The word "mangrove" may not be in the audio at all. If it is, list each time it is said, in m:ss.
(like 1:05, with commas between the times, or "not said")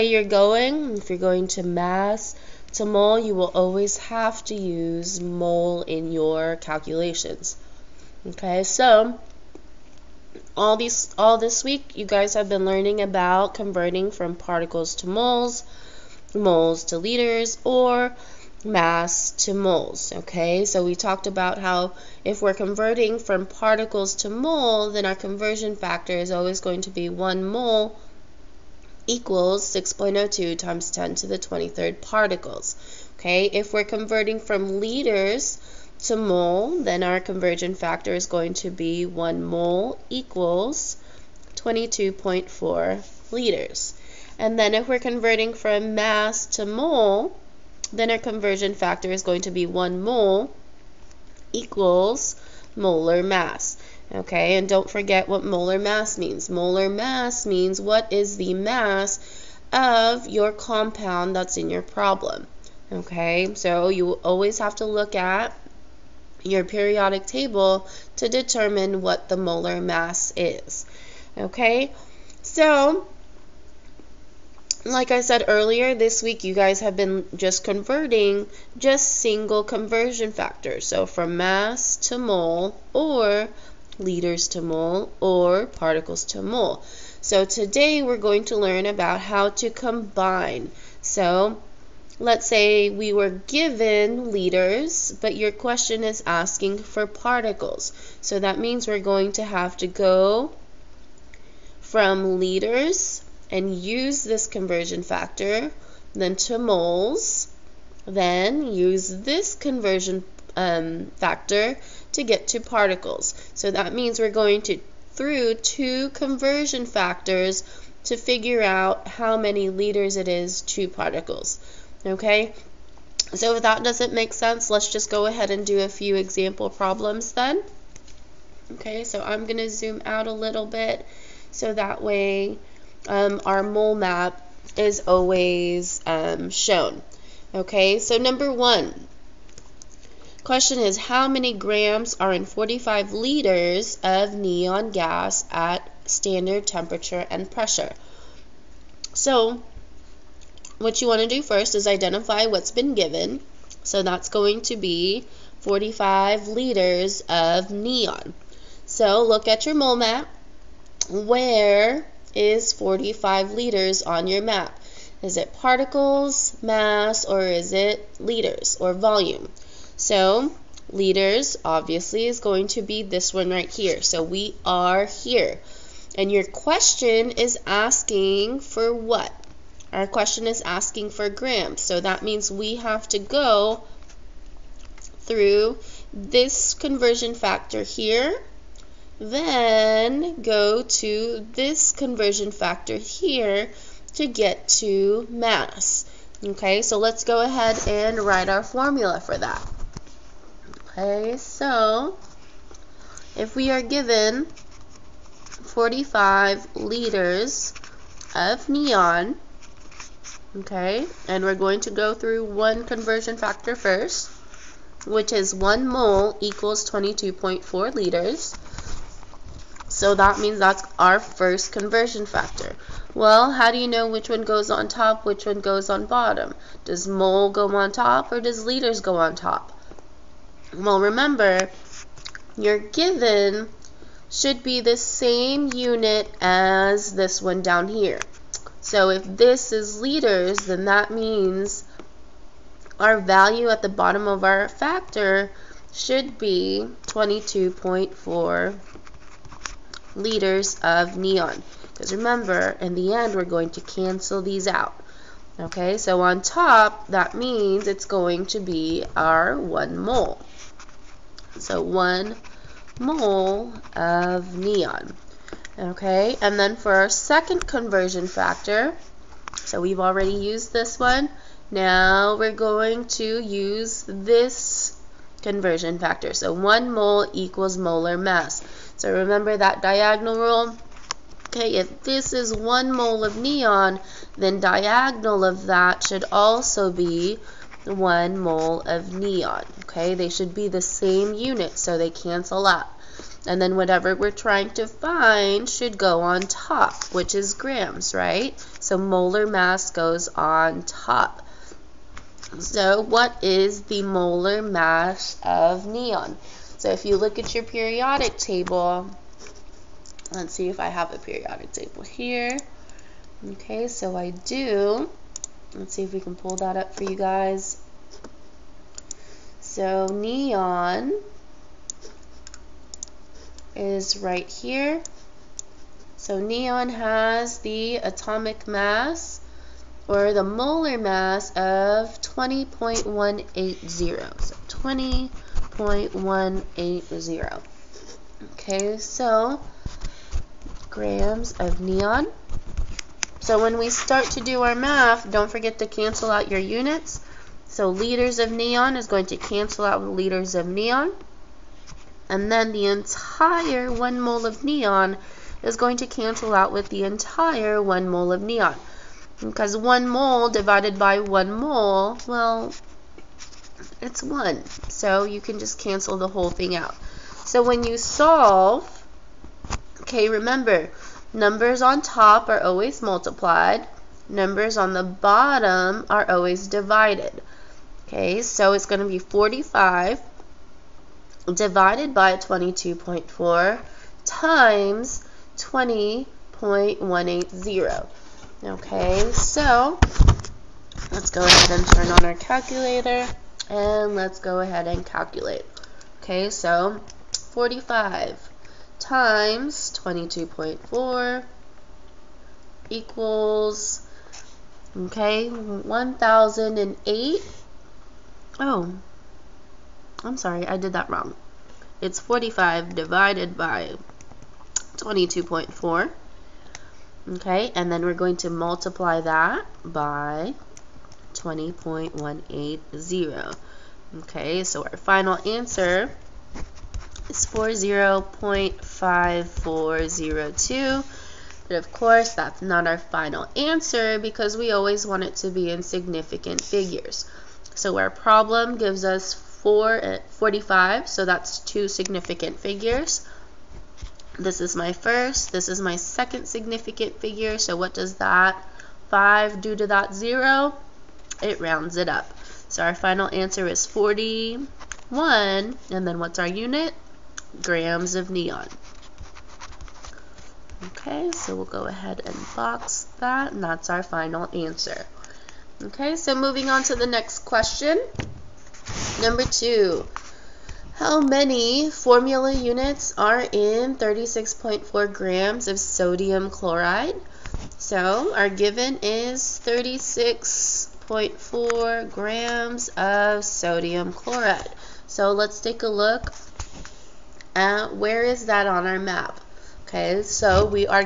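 not said.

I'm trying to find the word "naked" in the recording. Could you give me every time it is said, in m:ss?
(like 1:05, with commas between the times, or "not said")
not said.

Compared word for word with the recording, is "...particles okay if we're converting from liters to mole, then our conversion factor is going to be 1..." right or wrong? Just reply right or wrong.
right.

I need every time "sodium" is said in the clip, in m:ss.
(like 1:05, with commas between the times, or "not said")
7:55, 8:03.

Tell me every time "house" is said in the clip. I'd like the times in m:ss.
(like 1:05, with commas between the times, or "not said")
not said.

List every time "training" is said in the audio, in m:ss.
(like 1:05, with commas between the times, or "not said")
not said.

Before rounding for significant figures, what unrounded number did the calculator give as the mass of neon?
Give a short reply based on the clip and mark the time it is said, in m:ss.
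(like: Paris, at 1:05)
40.5402, at 7:07.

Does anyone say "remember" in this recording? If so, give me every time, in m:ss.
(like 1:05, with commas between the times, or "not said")
3:50, 4:12, 4:39, 6:10.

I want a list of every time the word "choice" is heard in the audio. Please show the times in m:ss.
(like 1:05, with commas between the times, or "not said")
not said.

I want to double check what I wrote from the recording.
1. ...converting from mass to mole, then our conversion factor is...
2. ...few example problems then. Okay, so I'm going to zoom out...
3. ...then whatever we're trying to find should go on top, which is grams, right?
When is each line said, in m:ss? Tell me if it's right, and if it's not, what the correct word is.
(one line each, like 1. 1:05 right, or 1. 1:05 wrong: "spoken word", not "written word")
1. 0:44 right
2. 2:05 right
3. 4:53 right.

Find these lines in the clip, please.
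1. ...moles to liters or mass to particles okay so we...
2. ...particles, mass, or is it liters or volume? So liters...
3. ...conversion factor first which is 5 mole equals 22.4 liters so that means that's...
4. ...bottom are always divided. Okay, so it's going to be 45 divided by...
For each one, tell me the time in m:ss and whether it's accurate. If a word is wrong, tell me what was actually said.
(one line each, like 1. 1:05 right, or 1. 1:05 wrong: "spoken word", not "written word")
1. 0:16 wrong: "moles", not "particles"
2. 2:45 right
3. 3:32 wrong: "1", not "5"
4. 6:15 right.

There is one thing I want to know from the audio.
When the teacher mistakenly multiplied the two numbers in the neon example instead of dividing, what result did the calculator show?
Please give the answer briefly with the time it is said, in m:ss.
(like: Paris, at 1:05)
1008, at 6:45.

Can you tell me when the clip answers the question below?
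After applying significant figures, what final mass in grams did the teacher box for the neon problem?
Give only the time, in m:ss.
7:33.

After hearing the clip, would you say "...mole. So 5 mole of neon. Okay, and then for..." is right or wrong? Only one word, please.
wrong.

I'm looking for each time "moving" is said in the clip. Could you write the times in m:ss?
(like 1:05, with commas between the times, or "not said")
7:46.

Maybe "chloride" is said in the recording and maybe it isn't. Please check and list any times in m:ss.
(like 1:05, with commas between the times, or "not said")
7:56, 8:04.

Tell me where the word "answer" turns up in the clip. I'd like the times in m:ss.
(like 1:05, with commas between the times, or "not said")
7:05, 7:13, 7:33, 7:44.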